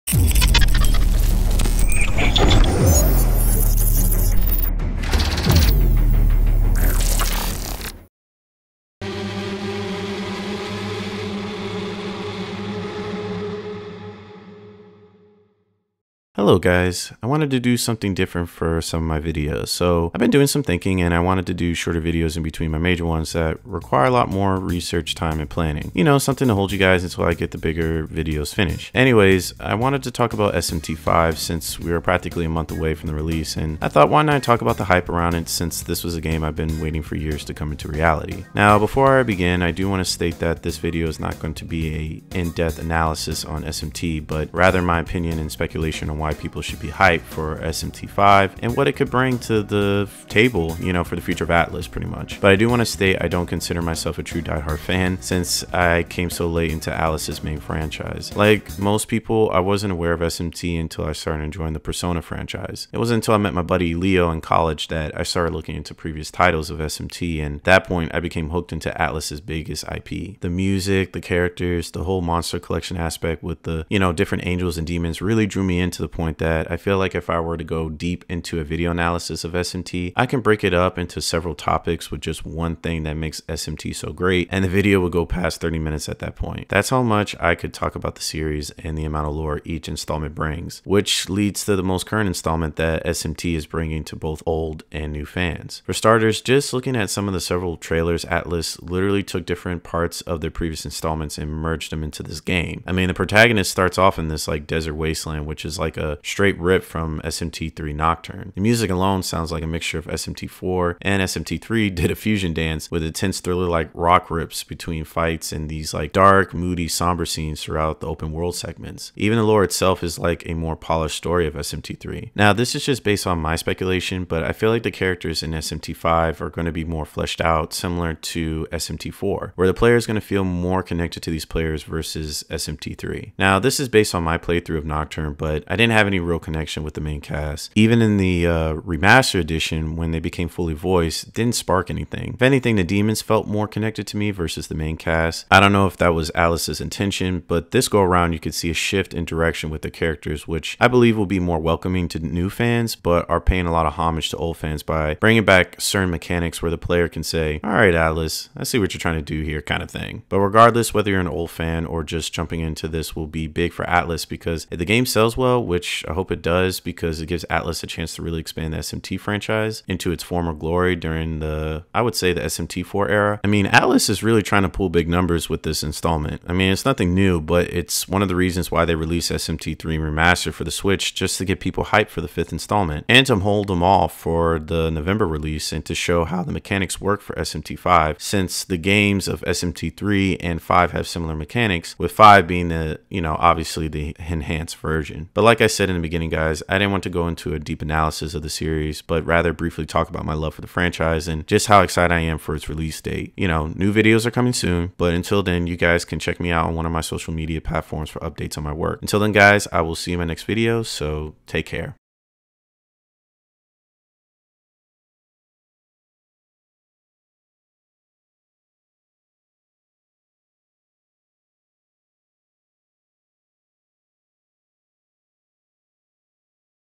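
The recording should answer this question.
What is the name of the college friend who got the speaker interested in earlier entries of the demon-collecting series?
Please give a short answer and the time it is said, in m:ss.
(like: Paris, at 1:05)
Leo, at 1:03.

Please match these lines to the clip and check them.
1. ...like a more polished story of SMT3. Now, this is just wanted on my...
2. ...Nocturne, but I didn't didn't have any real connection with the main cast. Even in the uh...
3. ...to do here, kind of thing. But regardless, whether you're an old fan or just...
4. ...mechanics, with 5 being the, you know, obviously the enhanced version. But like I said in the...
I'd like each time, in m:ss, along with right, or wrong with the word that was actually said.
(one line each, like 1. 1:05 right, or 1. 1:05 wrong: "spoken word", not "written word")
1. 2:00 wrong: "based", not "wanted"
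2. 2:14 right
3. 2:39 right
4. 3:11 right.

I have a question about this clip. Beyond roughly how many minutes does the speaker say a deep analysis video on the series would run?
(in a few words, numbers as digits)
30 minutes.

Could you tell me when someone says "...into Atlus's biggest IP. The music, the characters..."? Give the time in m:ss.
1:08.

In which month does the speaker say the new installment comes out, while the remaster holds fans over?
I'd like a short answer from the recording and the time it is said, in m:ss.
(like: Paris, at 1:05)
November, at 3:04.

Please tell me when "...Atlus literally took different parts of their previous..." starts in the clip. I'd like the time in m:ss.
1:38.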